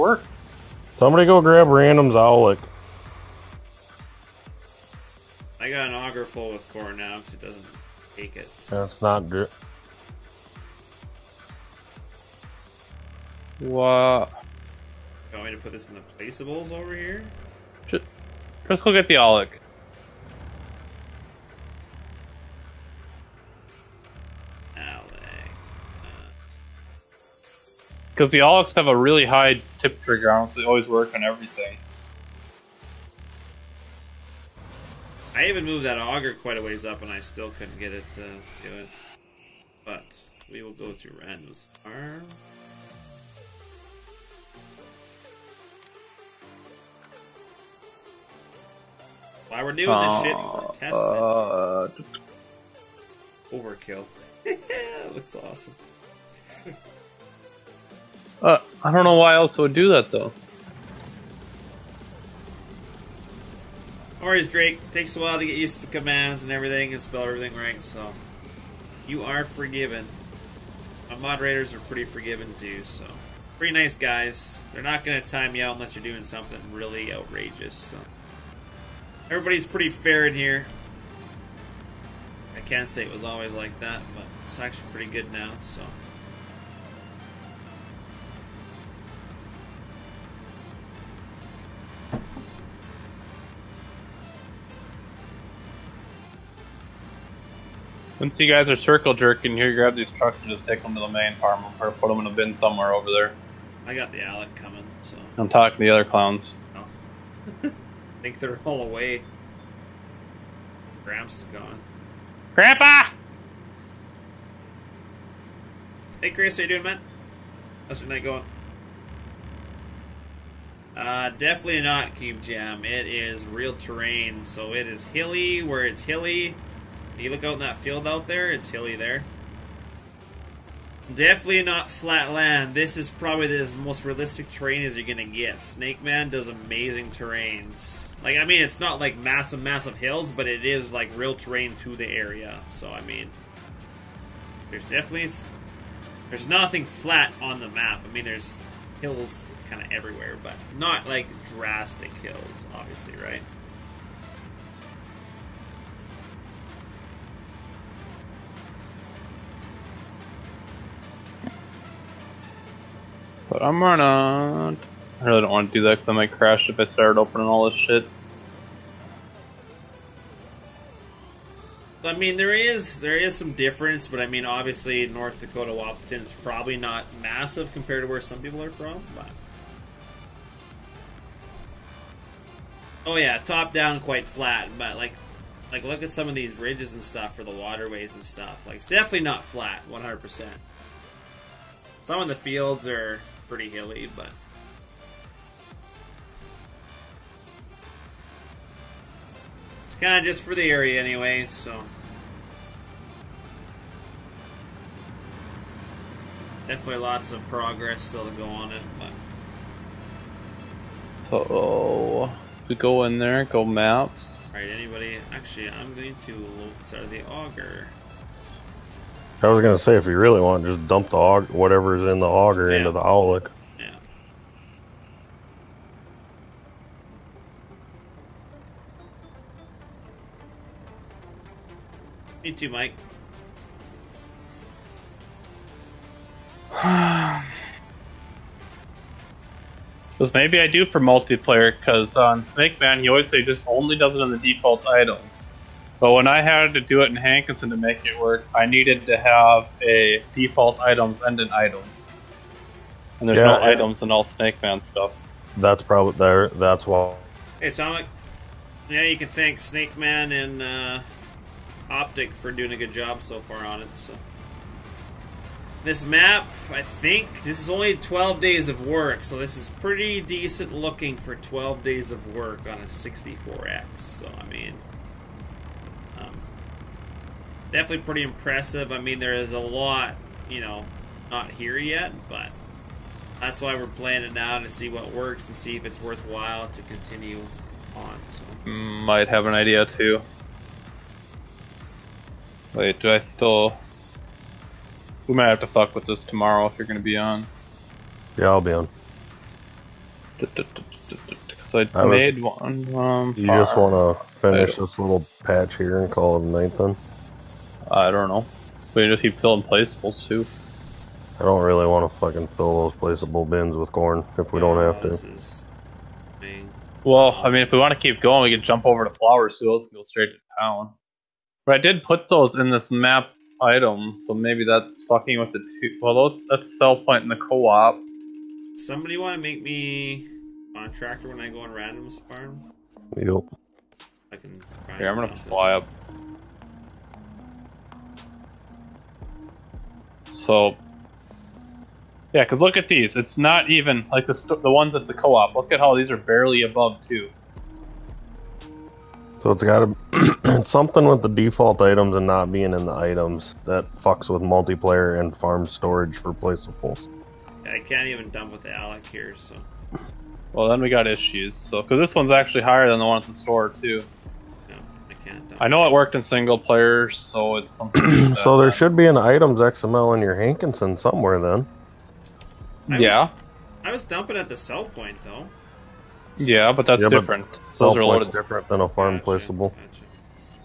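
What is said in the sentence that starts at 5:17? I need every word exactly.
Well, I mean, if we want to keep going, we can jump over to flowers.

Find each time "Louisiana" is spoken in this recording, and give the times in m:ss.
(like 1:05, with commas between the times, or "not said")
not said.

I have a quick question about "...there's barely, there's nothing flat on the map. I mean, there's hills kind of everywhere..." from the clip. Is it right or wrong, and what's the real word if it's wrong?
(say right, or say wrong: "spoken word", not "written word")
wrong: "definitely", not "barely".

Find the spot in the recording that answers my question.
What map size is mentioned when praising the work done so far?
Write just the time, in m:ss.
4:32.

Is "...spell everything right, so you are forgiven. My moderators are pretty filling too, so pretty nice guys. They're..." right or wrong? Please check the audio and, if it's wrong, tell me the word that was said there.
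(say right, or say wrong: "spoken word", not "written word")
wrong: "forgiving", not "filling".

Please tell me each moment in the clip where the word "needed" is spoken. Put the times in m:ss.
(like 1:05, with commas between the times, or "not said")
4:08.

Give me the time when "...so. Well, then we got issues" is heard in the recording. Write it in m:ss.
5:59.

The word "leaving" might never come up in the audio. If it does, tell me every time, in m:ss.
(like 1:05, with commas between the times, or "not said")
not said.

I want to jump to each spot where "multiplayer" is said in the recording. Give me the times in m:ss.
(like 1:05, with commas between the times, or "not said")
4:01, 5:54.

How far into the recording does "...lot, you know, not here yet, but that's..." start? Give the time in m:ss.
4:39.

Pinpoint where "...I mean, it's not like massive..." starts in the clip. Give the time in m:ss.
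2:18.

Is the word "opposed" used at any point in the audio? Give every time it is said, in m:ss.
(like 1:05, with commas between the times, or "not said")
not said.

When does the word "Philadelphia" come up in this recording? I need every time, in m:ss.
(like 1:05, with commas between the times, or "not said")
not said.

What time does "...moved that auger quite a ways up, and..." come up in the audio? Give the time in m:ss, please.
0:35.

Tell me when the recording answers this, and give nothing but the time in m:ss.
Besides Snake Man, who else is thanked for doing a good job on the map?
4:21.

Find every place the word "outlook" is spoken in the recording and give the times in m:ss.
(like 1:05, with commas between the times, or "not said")
3:43.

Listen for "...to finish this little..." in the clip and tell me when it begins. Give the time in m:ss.
5:04.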